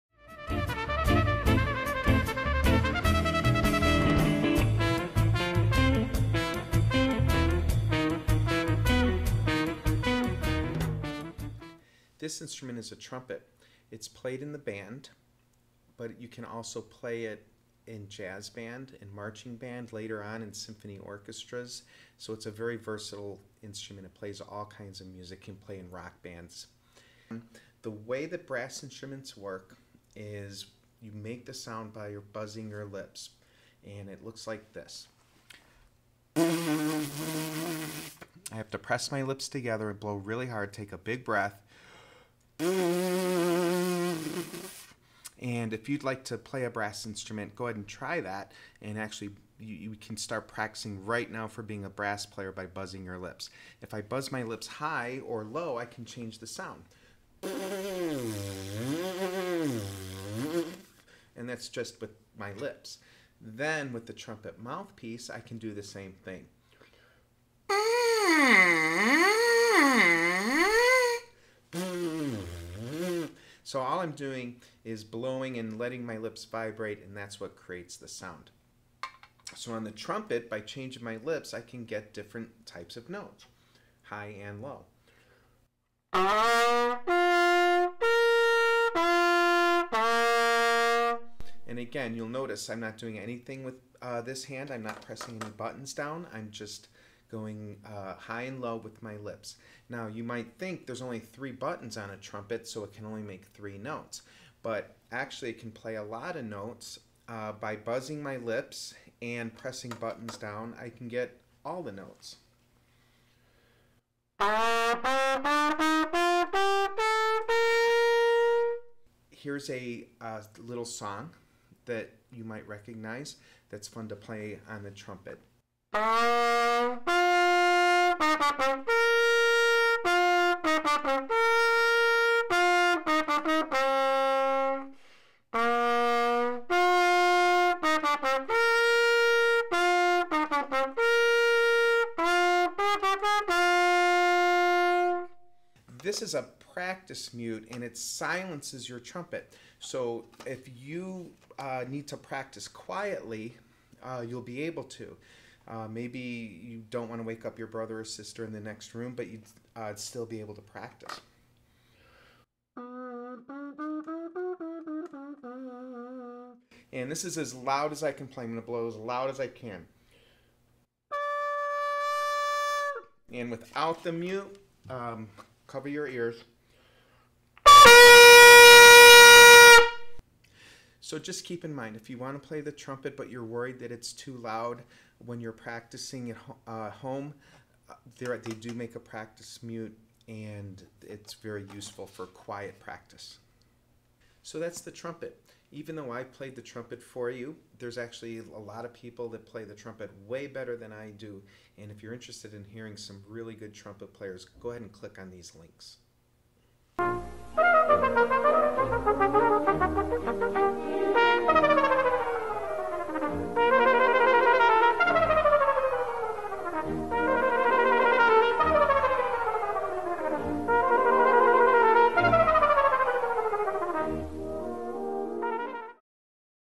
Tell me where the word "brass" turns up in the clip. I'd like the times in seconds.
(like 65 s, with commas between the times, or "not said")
28 s, 46 s, 51 s.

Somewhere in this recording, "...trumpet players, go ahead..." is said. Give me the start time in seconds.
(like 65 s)
203 s.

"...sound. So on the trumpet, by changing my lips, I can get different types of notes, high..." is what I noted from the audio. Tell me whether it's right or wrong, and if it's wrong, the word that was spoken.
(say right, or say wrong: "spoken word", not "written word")
right.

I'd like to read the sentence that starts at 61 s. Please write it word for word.
And that's just with my lips.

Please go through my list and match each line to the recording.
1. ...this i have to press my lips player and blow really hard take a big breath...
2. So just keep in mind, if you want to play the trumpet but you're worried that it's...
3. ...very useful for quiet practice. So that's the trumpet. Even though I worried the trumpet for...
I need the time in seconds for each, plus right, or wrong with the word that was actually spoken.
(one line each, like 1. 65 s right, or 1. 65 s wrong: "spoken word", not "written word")
1. 34 s wrong: "together", not "player"
2. 180 s right
3. 191 s wrong: "played", not "worried".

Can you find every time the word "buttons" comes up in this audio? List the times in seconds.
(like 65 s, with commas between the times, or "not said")
95 s, 101 s, 109 s.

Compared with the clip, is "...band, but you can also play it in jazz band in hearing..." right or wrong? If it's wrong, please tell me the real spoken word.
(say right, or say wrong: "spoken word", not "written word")
wrong: "marching", not "hearing".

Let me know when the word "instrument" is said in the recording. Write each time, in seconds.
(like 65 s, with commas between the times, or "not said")
12 s, 23 s, 28 s, 47 s.